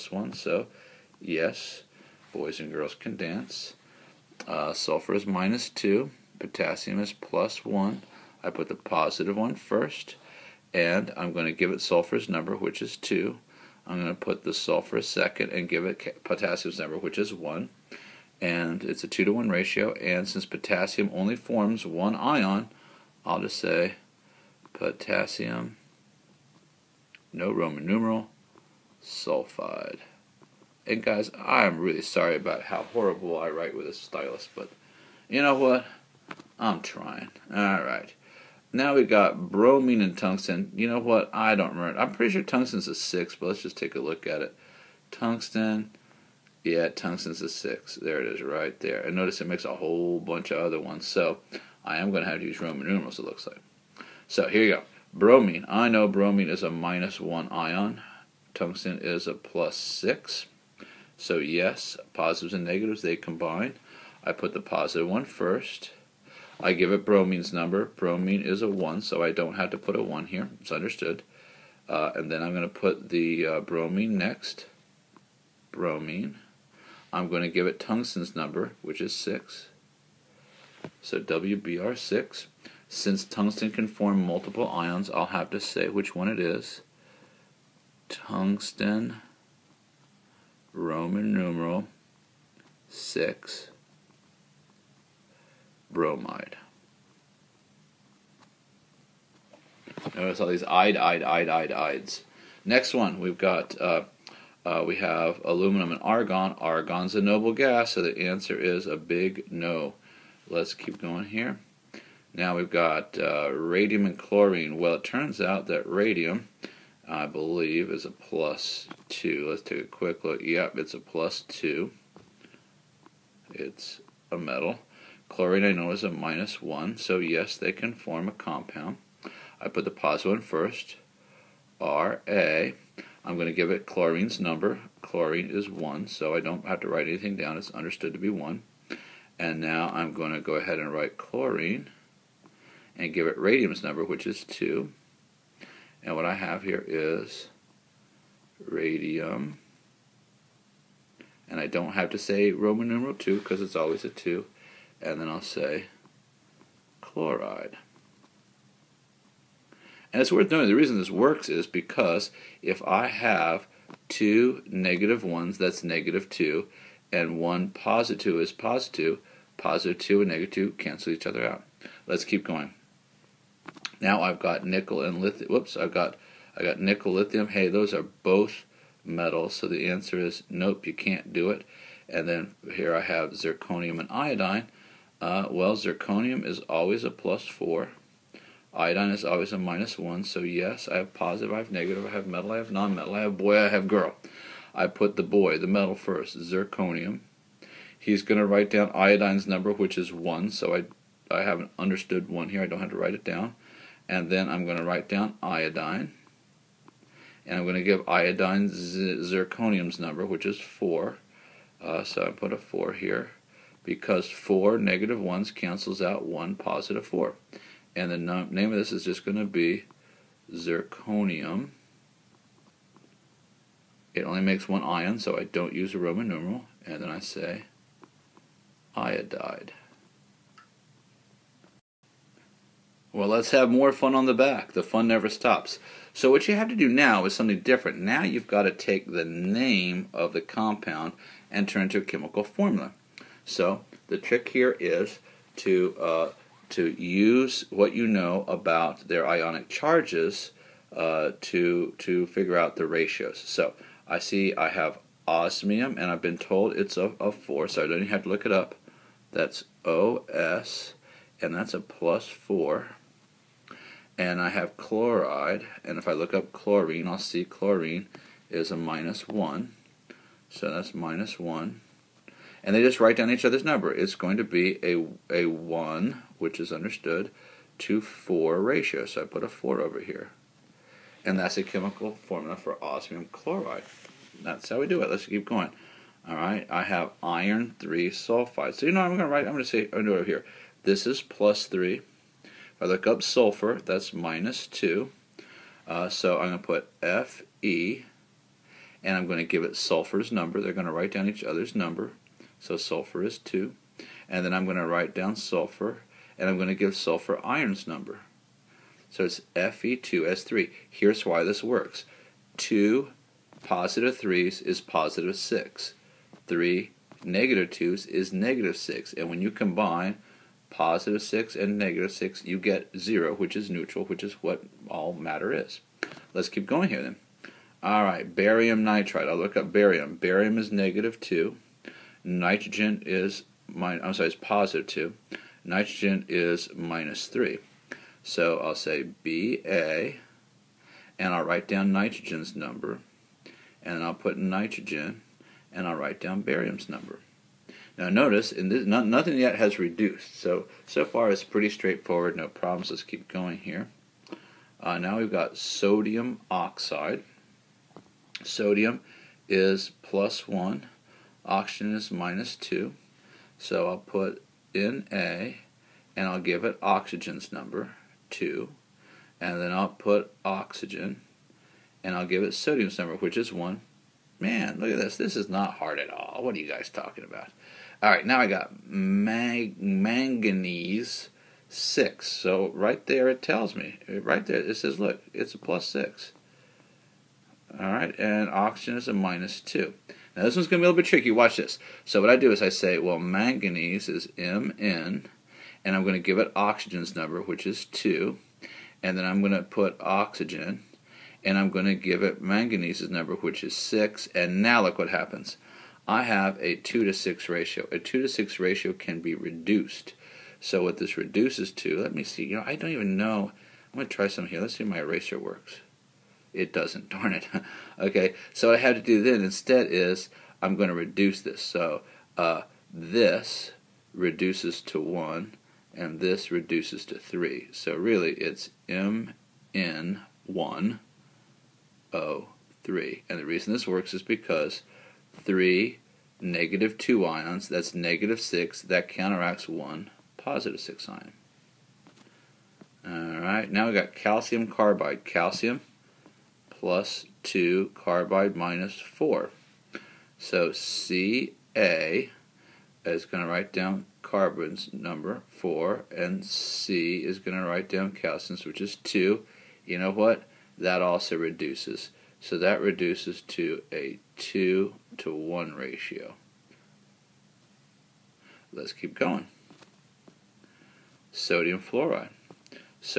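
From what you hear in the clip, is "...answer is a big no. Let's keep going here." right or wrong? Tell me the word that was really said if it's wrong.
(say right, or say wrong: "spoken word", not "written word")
right.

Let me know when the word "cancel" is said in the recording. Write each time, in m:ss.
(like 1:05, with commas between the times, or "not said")
2:50, 3:35.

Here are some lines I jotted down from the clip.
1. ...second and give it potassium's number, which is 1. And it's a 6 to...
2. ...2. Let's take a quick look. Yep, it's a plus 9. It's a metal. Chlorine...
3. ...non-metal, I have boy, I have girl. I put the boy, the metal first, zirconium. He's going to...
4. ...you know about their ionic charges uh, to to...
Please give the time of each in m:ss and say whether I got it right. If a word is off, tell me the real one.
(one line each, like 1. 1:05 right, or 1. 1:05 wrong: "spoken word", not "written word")
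1. 0:15 wrong: "2", not "6"
2. 1:59 wrong: "2", not "9"
3. 3:12 right
4. 4:07 right.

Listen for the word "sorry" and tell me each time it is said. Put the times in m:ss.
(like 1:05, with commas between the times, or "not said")
0:32, 5:34.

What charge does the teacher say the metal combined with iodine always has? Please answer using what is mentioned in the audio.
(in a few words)
Plus 4.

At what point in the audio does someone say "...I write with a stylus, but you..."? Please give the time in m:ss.
0:33.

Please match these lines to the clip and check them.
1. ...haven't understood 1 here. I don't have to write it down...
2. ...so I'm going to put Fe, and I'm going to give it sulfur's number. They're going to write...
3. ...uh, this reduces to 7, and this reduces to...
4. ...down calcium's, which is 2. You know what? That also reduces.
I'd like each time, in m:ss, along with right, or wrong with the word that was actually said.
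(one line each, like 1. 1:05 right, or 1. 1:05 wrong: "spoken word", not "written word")
1. 3:21 right
2. 4:56 right
3. 7:02 wrong: "1", not "7"
4. 7:37 right.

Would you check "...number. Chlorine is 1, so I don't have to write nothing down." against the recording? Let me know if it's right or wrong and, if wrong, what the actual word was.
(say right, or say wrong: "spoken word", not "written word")
wrong: "anything", not "nothing".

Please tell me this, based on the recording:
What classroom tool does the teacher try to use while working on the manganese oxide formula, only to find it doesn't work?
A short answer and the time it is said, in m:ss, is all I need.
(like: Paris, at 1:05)
Eraser, at 6:54.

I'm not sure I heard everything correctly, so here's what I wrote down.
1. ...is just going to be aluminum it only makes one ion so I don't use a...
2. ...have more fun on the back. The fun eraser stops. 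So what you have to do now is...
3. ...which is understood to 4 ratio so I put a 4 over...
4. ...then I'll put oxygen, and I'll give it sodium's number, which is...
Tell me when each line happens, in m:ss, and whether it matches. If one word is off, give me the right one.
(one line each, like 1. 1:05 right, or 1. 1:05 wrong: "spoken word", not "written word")
1. 3:38 wrong: "zirconium", not "aluminum"
2. 3:53 wrong: "never", not "eraser"
3. 4:36 right
4. 6:09 right.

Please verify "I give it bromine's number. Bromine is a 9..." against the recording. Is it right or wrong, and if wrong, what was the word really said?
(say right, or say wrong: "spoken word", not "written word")
wrong: "1", not "9".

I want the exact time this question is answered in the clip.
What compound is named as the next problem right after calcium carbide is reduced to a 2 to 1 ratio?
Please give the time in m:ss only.
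7:51.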